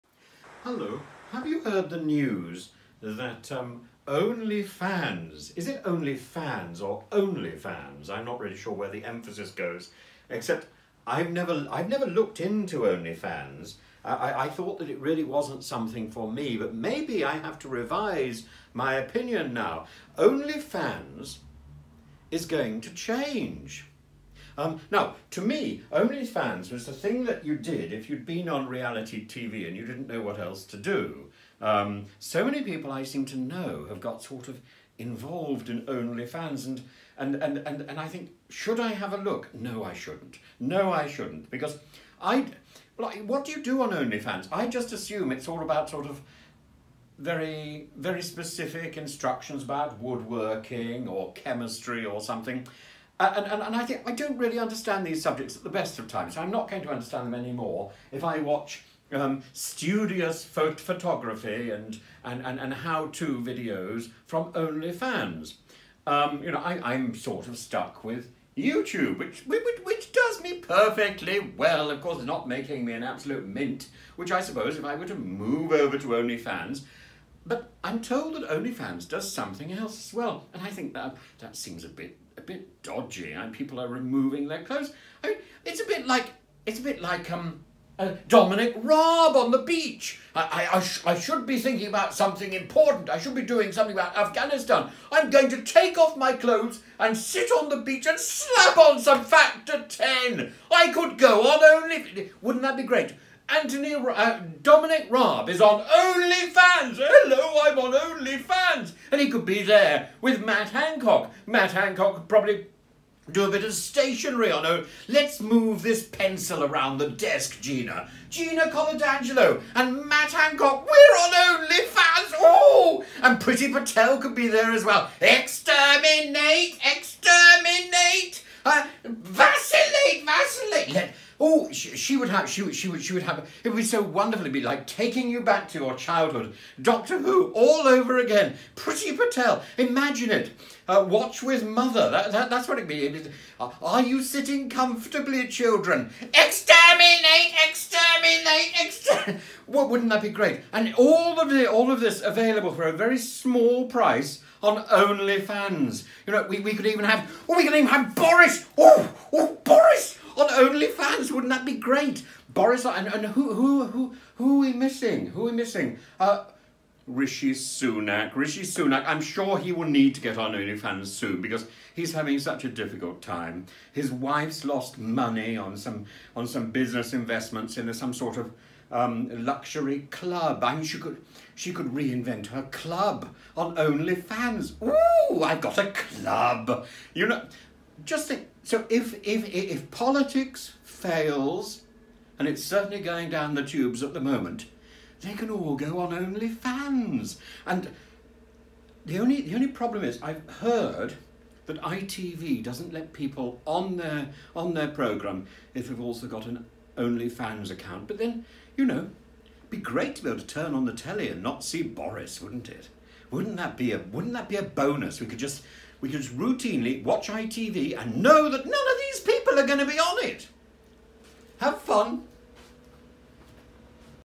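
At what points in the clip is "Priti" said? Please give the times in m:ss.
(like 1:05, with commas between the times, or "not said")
2:03, 2:18.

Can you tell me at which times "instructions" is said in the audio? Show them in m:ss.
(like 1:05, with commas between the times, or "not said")
0:48.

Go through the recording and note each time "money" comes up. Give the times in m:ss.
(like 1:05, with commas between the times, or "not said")
2:54.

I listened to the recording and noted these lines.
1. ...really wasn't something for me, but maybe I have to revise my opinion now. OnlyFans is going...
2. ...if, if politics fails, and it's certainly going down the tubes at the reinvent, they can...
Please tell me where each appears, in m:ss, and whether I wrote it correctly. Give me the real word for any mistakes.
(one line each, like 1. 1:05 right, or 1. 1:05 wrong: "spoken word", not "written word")
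1. 0:14 right
2. 3:09 wrong: "moment", not "reinvent".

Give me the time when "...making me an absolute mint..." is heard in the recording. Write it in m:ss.
1:12.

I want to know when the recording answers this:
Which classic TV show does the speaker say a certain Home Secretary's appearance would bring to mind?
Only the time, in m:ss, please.
2:16.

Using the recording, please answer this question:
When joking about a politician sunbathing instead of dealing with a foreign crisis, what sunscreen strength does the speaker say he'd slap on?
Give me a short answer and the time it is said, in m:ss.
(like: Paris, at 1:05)
factor 10, at 1:39.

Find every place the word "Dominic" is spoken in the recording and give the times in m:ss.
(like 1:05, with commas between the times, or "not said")
1:28, 1:44.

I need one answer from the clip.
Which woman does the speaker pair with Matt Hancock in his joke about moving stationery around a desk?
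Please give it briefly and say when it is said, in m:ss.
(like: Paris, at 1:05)
Gina Coladangelo, at 1:58.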